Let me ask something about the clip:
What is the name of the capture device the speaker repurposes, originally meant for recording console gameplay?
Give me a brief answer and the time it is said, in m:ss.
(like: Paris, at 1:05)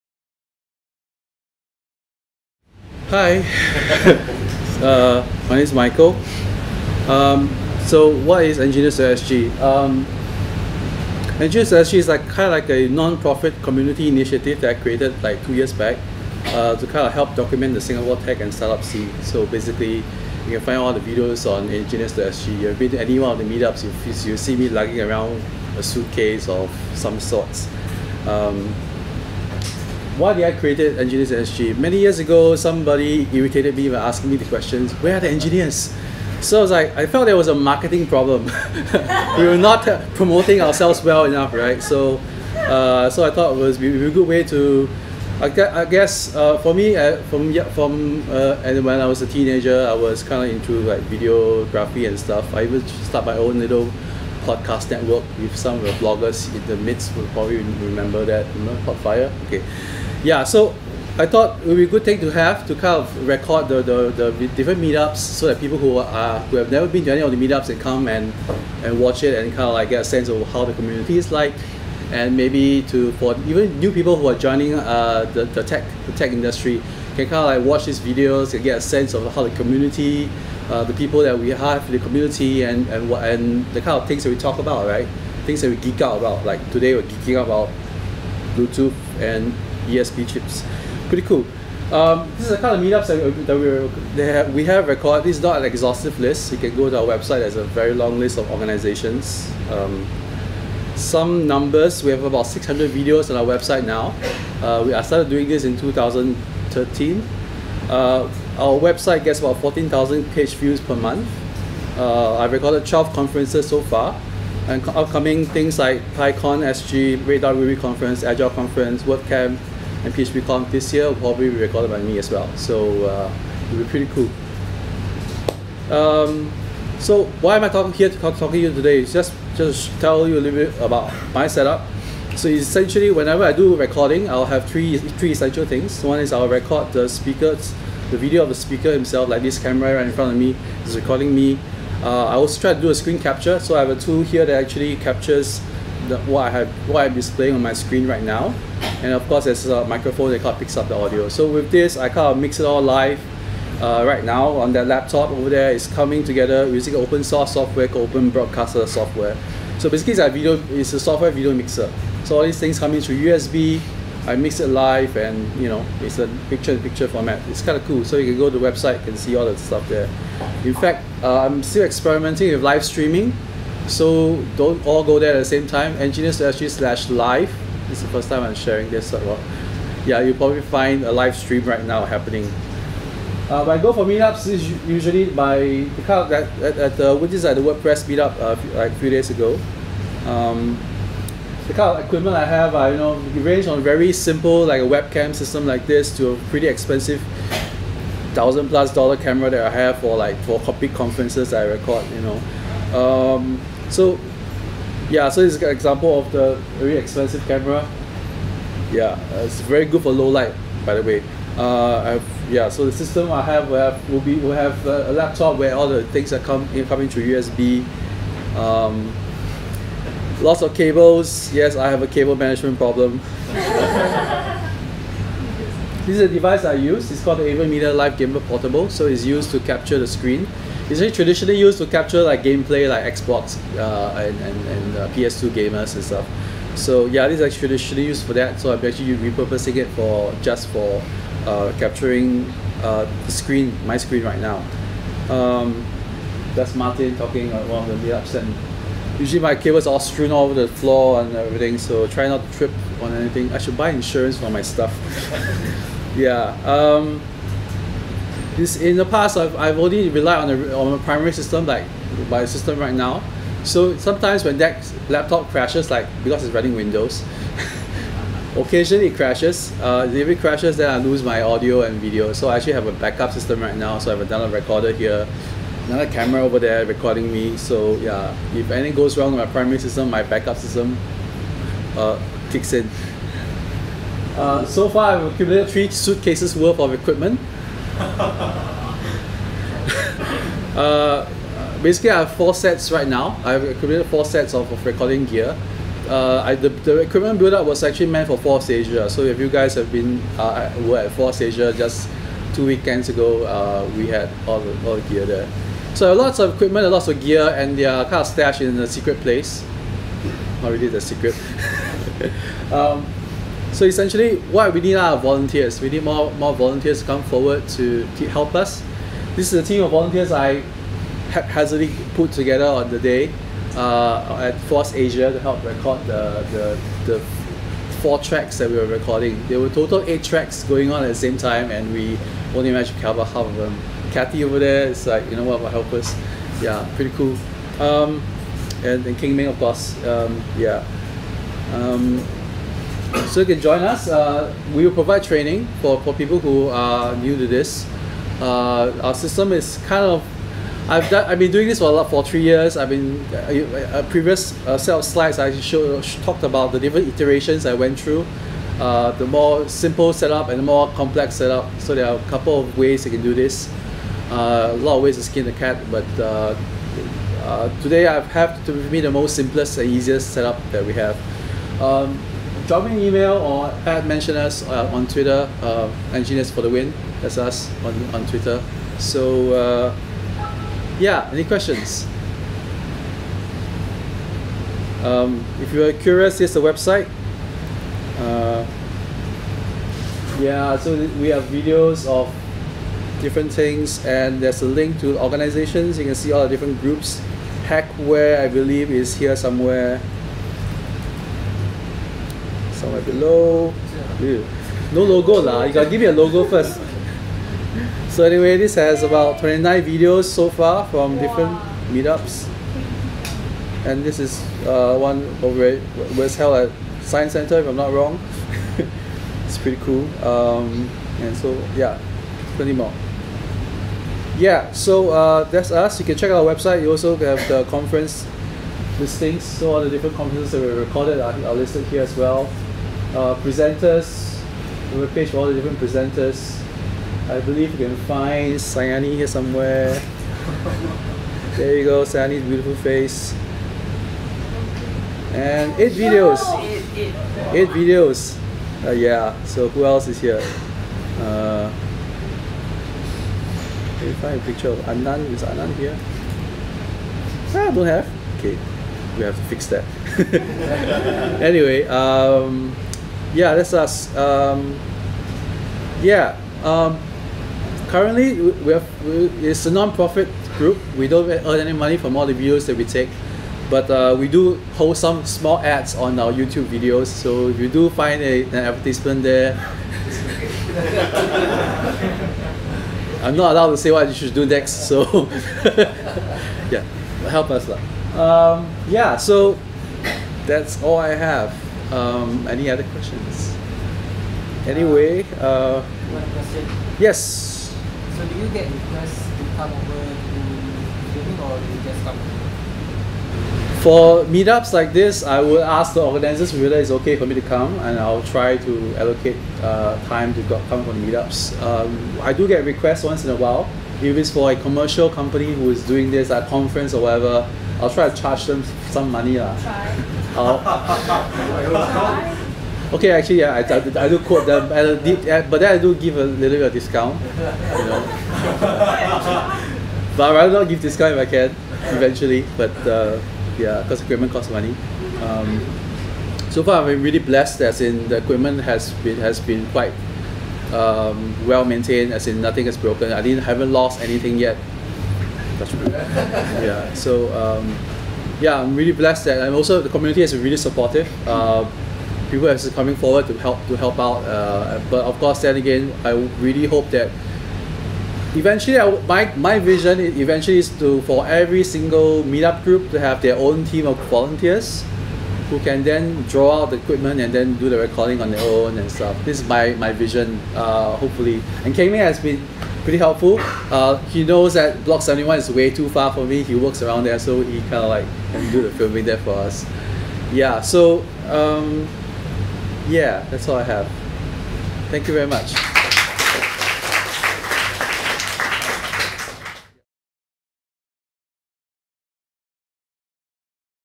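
AVerMedia Live Gamer Portable, at 3:47.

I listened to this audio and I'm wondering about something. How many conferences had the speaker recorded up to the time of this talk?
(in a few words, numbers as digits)
12.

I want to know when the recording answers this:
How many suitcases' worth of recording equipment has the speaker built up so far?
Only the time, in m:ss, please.
4:45.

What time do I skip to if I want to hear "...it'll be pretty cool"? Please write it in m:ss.
2:03.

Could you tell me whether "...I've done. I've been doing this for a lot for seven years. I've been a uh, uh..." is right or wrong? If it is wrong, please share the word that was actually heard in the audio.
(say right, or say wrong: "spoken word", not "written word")
wrong: "three", not "seven".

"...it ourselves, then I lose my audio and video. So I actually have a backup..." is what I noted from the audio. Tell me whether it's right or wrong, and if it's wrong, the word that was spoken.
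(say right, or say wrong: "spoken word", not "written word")
wrong: "crashes", not "ourselves".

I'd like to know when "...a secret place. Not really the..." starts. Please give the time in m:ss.
5:08.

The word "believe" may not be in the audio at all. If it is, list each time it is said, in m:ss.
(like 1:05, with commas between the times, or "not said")
6:38, 7:17.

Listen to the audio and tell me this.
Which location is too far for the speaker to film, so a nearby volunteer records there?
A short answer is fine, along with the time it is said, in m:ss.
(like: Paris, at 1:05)
Block 71, at 9:34.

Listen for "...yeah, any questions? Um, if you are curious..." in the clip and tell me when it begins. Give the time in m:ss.
6:21.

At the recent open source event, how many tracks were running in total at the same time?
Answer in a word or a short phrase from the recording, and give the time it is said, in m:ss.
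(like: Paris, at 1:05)
8, at 5:30.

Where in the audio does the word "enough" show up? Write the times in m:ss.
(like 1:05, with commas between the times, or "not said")
0:41.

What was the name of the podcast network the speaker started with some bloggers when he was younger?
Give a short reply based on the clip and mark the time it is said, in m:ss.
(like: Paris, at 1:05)
Podfire, at 0:58.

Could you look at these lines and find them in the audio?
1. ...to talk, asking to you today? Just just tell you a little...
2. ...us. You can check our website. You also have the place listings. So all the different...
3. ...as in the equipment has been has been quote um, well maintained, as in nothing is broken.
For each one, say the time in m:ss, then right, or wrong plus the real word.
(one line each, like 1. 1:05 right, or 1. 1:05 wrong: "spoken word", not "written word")
1. 2:08 wrong: "talking", not "asking"
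2. 7:05 wrong: "conference", not "place"
3. 8:57 wrong: "quite", not "quote".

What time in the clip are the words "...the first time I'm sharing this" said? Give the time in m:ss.
2:58.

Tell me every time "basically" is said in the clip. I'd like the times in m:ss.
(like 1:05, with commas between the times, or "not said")
0:19, 2:39, 4:51.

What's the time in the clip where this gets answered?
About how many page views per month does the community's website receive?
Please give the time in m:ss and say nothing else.
1:49.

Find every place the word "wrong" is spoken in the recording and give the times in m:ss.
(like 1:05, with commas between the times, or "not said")
4:39, 6:57.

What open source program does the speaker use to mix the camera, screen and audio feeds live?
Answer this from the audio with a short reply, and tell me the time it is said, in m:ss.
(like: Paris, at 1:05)
Open Broadcaster Software, at 2:38.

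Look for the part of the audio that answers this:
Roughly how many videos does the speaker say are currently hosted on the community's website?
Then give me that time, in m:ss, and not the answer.
1:42.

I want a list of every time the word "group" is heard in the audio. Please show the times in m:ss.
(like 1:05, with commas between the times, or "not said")
6:36, 7:50, 9:22.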